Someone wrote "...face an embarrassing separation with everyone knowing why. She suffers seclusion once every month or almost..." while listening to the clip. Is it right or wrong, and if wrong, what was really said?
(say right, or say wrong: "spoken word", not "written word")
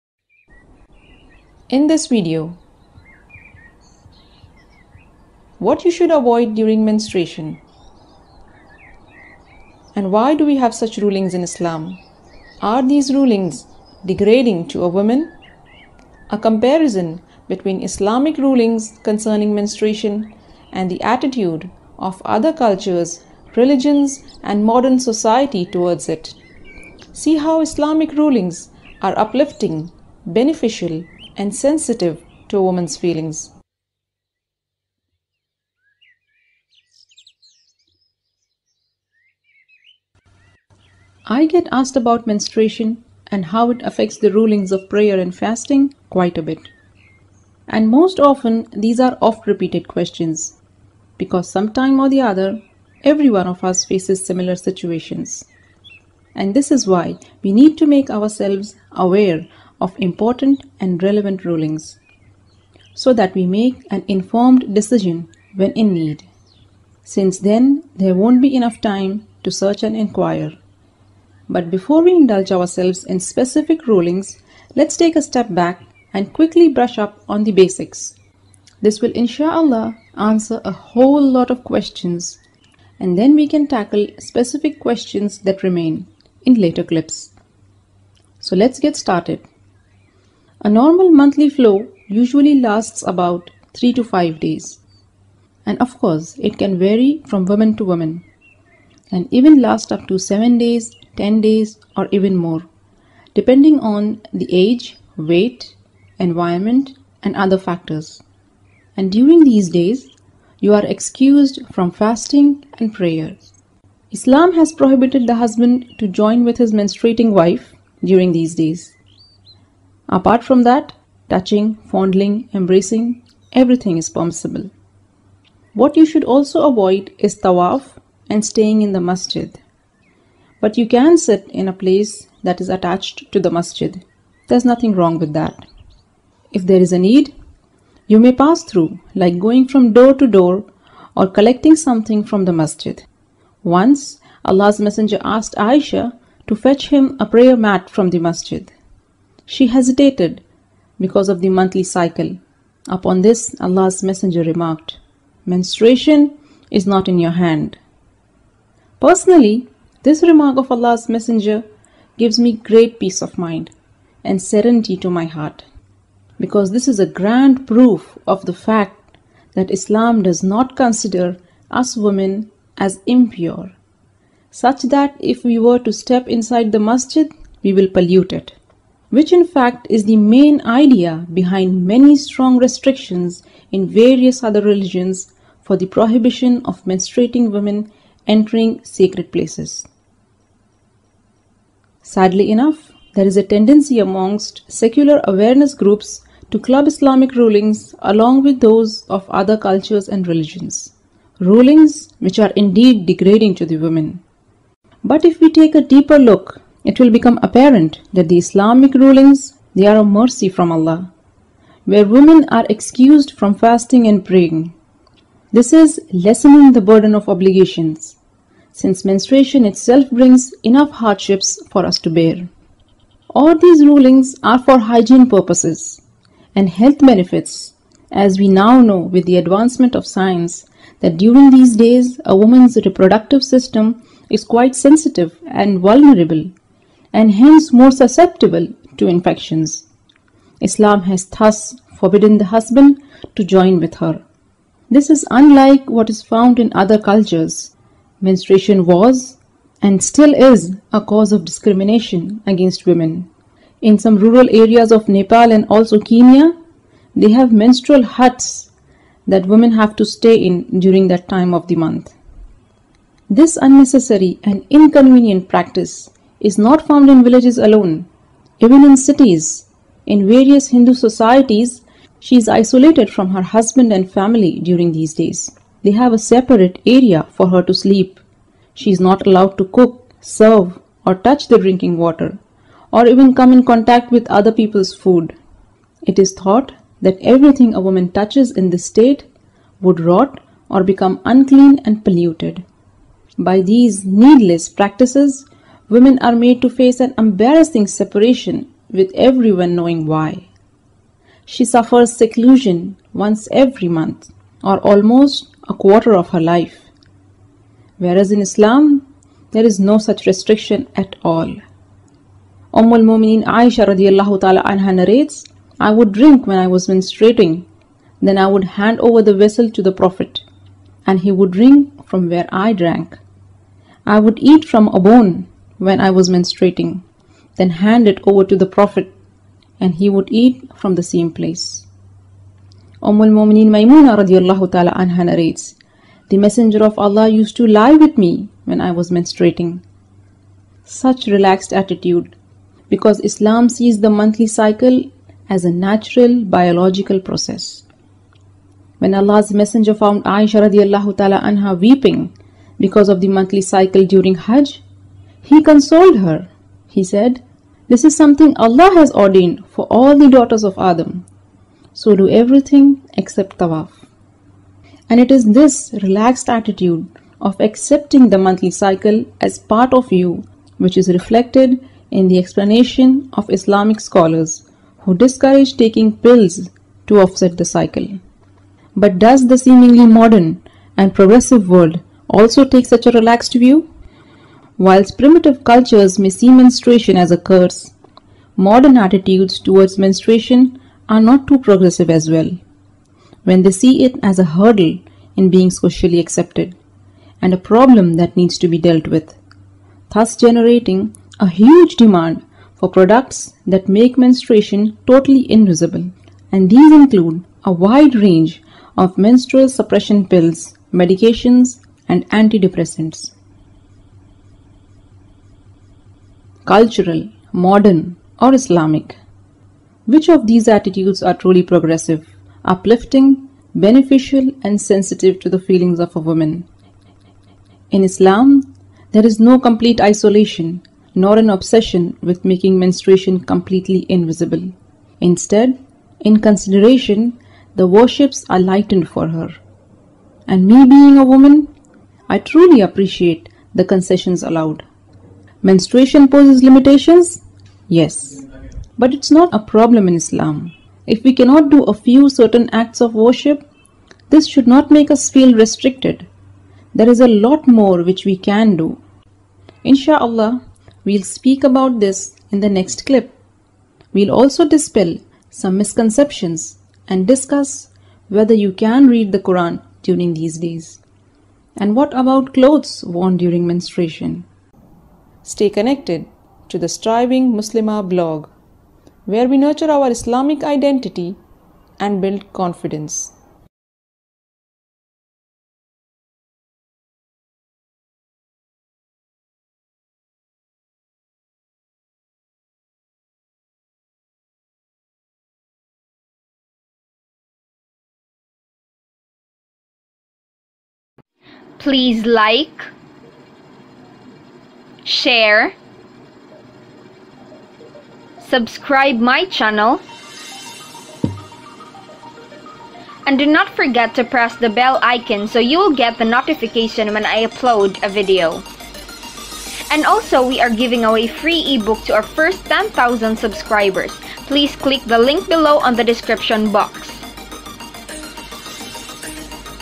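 right.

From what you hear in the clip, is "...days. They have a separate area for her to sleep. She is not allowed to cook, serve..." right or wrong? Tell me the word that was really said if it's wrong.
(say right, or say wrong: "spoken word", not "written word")
right.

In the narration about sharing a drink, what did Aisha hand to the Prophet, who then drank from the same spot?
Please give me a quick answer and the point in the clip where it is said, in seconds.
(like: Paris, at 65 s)
Vessel, at 319 s.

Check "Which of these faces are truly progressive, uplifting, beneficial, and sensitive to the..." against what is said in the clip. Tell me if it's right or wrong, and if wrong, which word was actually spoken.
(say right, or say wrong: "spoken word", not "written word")
wrong: "attitudes", not "faces".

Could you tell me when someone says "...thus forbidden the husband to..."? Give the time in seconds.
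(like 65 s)
241 s.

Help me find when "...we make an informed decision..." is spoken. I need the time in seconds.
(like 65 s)
63 s.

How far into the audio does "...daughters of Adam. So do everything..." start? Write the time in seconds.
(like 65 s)
360 s.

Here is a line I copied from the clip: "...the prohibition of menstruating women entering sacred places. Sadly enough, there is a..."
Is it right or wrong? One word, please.
right.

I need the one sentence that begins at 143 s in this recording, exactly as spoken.
Once, Allah's Messenger asked Aisha to fetch him a prayer mat from the masjid.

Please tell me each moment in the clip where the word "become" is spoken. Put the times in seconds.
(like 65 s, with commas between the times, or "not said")
207 s, 290 s.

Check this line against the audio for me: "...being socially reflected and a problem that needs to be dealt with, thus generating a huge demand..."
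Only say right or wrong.
wrong.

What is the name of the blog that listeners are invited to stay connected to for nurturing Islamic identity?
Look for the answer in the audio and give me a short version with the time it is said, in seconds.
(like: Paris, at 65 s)
Striving Muslima, at 476 s.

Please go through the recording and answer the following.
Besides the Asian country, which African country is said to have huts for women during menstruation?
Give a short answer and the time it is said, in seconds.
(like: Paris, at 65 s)
Kenya, at 255 s.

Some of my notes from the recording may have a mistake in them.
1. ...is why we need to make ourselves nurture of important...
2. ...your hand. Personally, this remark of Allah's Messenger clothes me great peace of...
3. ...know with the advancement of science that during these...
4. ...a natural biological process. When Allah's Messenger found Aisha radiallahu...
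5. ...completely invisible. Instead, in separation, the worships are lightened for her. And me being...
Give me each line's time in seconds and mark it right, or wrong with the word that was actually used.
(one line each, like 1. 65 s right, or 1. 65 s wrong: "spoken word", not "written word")
1. 56 s wrong: "aware", not "nurture"
2. 157 s wrong: "gives", not "clothes"
3. 228 s right
4. 345 s right
5. 433 s wrong: "consideration", not "separation".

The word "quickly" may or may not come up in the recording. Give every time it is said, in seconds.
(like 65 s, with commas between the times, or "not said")
76 s.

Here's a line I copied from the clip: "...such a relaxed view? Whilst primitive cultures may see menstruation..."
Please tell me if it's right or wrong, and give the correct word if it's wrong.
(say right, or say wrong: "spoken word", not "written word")
right.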